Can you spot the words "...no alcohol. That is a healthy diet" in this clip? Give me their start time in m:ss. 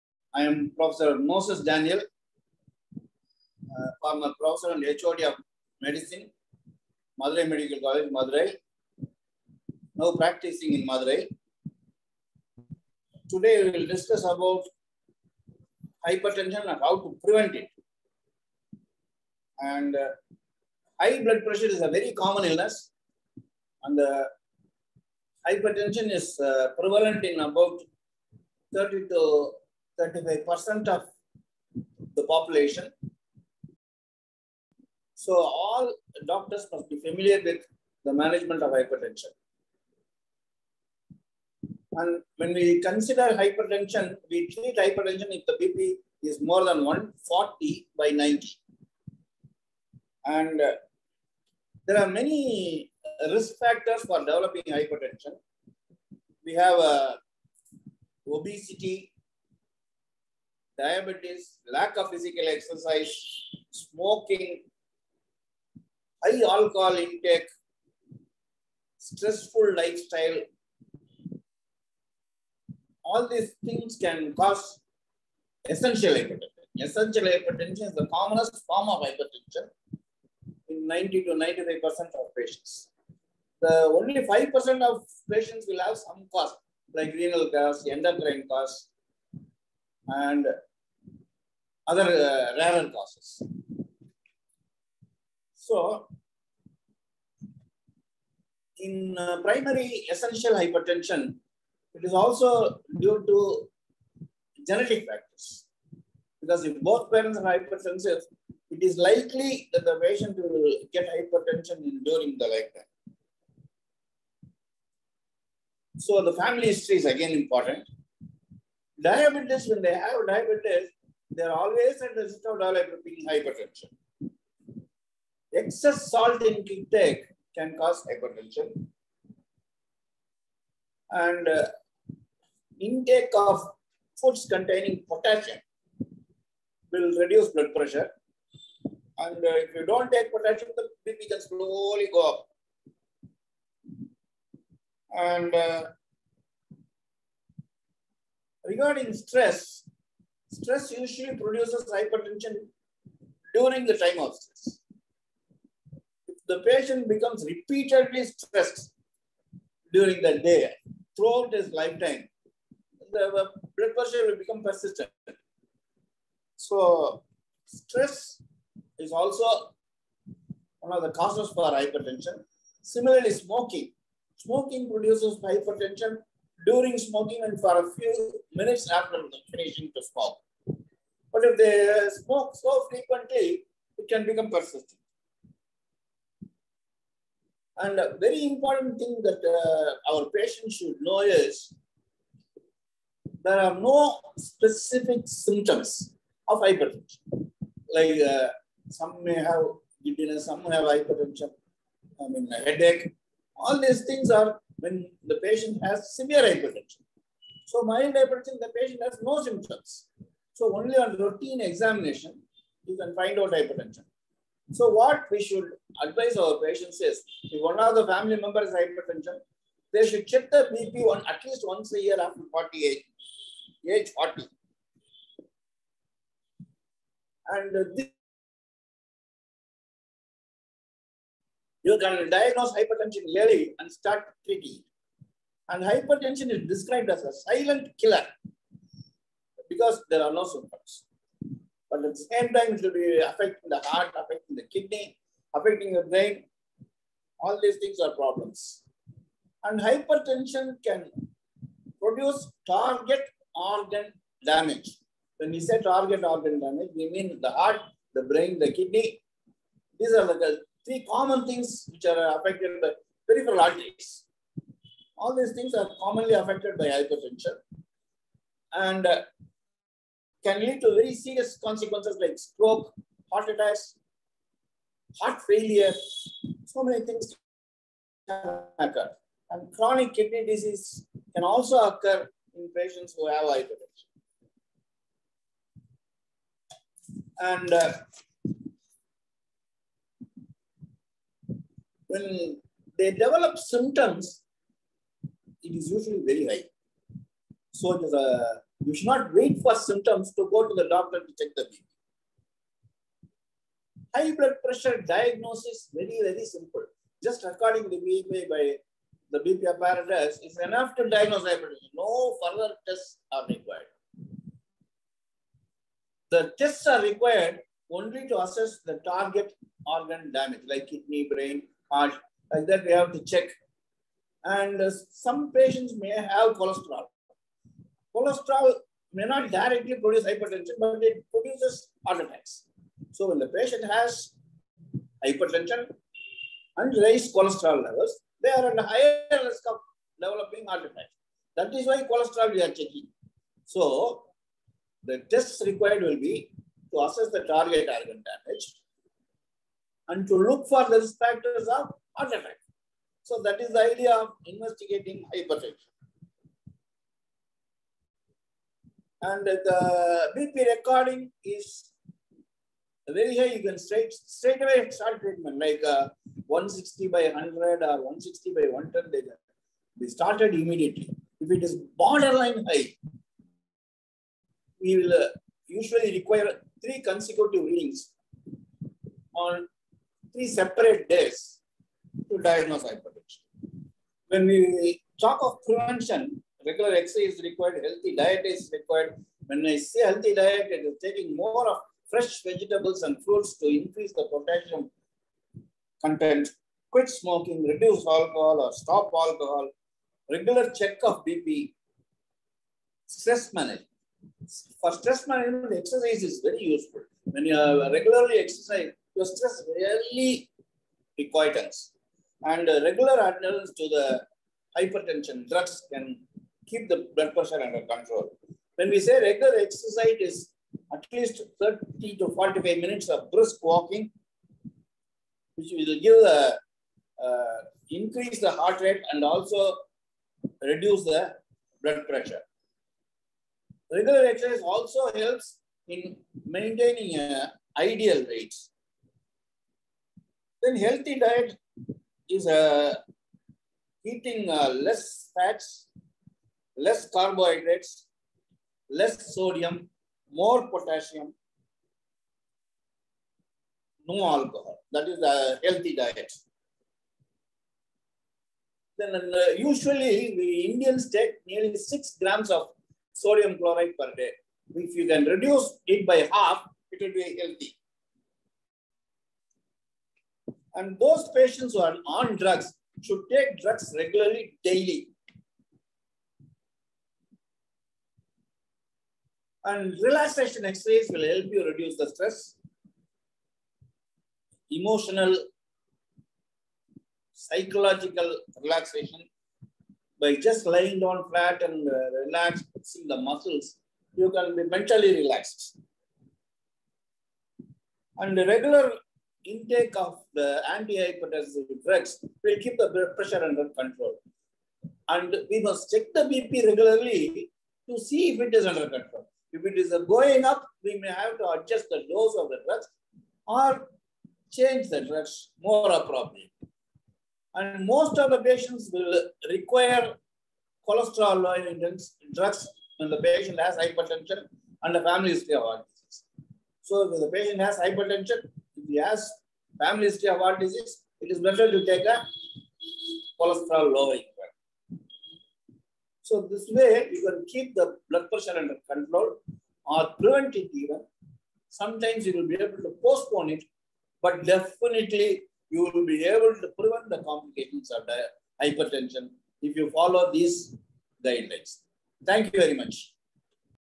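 7:34.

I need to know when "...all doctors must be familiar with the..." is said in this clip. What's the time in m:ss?
0:35.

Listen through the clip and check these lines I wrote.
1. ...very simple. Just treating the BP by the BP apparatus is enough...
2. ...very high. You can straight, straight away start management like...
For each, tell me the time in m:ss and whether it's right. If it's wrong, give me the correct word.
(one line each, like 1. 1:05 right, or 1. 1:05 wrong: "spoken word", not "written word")
1. 5:06 wrong: "recording", not "treating"
2. 6:03 wrong: "treatment", not "management".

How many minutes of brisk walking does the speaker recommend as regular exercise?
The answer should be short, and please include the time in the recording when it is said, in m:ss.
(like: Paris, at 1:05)
30 to 45 minutes, at 7:01.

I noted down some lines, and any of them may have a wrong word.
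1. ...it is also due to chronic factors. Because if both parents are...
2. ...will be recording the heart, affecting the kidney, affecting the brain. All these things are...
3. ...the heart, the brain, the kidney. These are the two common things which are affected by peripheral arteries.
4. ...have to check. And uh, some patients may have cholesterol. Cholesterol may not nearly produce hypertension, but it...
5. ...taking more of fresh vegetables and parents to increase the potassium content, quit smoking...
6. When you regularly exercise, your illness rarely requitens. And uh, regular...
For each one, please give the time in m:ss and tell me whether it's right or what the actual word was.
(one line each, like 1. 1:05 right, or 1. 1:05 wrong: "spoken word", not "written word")
1. 1:41 wrong: "genetic", not "chronic"
2. 4:02 wrong: "affecting", not "recording"
3. 4:17 wrong: "three", not "two"
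4. 5:22 wrong: "directly", not "nearly"
5. 6:31 wrong: "fruits", not "parents"
6. 6:47 wrong: "stress", not "illness".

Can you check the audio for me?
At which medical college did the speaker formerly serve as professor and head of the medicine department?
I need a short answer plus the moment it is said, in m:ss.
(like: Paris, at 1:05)
Madurai Medical College, at 0:07.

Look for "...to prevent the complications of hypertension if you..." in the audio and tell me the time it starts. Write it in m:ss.
9:06.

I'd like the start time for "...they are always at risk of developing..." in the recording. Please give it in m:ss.
2:01.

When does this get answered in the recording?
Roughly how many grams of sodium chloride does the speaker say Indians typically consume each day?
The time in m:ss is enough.
7:41.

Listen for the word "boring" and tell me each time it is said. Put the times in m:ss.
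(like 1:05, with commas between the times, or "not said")
not said.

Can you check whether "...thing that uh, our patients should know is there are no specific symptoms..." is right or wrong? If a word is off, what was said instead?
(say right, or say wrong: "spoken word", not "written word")
right.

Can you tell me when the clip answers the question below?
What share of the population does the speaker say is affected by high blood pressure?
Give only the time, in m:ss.
0:28.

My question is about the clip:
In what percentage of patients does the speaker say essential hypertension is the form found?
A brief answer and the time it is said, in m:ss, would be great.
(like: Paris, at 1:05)
90 to 95%, at 1:20.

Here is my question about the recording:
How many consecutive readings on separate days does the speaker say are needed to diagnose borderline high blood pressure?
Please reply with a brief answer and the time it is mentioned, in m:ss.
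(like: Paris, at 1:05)
3, at 6:16.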